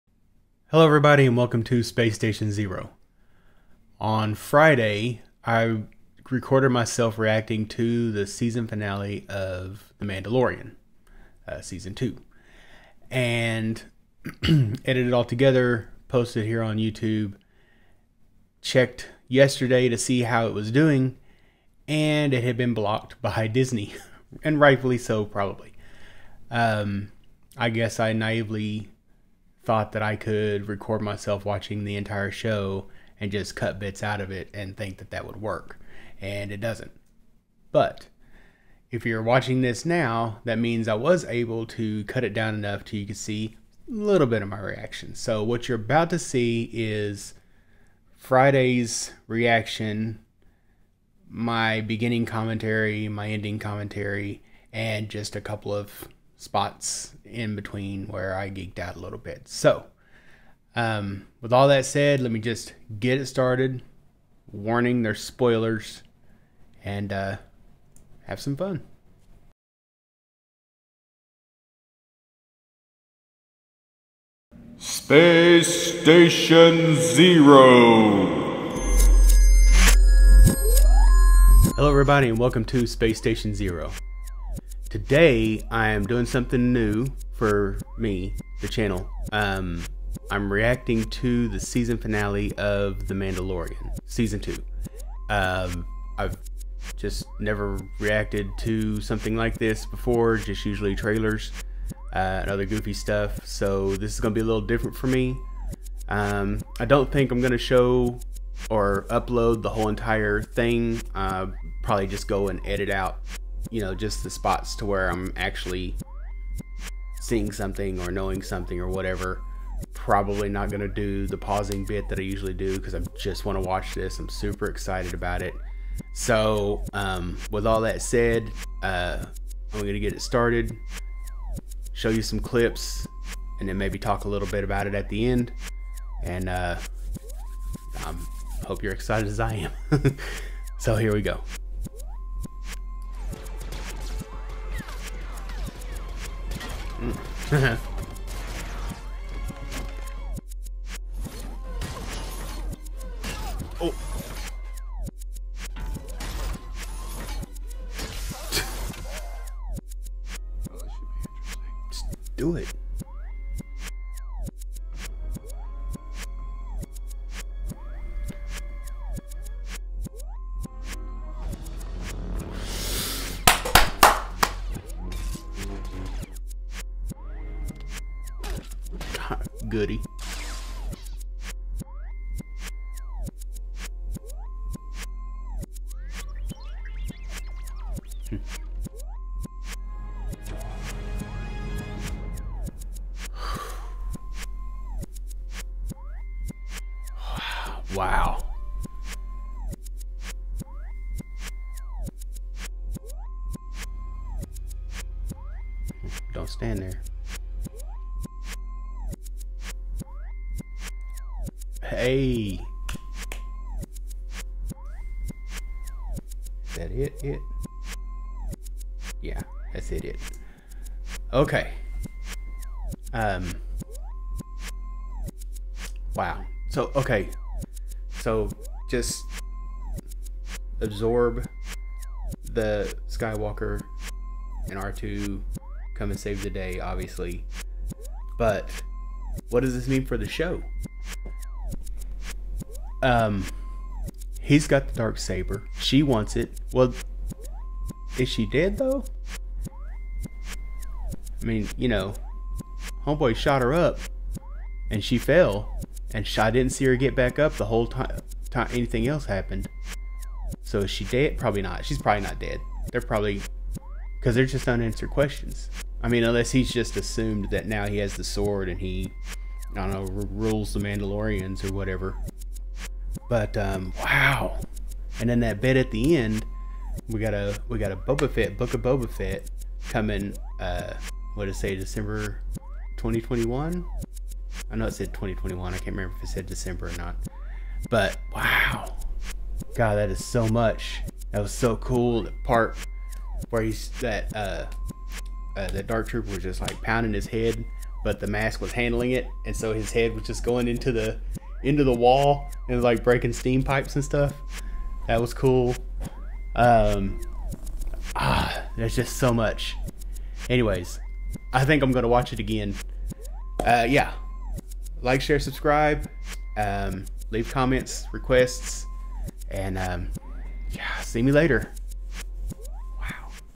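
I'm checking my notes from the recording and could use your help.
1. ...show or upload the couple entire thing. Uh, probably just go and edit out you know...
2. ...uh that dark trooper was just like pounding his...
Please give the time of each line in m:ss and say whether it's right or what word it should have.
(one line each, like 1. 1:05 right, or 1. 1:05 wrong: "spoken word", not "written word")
1. 1:47 wrong: "whole", not "couple"
2. 4:55 right.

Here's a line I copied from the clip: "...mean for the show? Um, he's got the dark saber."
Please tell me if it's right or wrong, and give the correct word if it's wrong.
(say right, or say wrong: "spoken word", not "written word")
right.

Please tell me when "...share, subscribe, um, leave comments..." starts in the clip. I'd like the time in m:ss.
5:15.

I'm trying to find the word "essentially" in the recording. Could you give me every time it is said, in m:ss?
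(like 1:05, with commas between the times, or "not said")
not said.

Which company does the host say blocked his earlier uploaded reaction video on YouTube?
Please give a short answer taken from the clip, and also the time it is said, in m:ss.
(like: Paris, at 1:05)
Disney, at 0:23.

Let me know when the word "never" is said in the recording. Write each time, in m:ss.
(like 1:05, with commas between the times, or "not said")
1:37.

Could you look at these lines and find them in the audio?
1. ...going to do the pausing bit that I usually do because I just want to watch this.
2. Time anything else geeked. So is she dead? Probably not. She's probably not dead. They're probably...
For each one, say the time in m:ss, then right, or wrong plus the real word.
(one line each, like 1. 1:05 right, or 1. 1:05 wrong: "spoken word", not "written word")
1. 2:00 right
2. 4:18 wrong: "happened", not "geeked".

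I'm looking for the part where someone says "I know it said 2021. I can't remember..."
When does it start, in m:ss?
4:44.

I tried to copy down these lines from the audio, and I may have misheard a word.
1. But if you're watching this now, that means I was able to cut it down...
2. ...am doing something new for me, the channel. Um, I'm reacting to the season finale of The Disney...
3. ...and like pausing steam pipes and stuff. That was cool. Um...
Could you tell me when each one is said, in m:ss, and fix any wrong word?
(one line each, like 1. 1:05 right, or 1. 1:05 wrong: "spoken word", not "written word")
1. 0:37 right
2. 1:25 wrong: "Mandalorian", not "Disney"
3. 5:02 wrong: "breaking", not "pausing".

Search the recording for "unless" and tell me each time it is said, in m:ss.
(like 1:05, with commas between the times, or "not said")
4:26.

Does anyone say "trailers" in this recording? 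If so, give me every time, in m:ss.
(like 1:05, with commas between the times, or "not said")
1:40.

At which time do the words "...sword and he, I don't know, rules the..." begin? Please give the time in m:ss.
4:28.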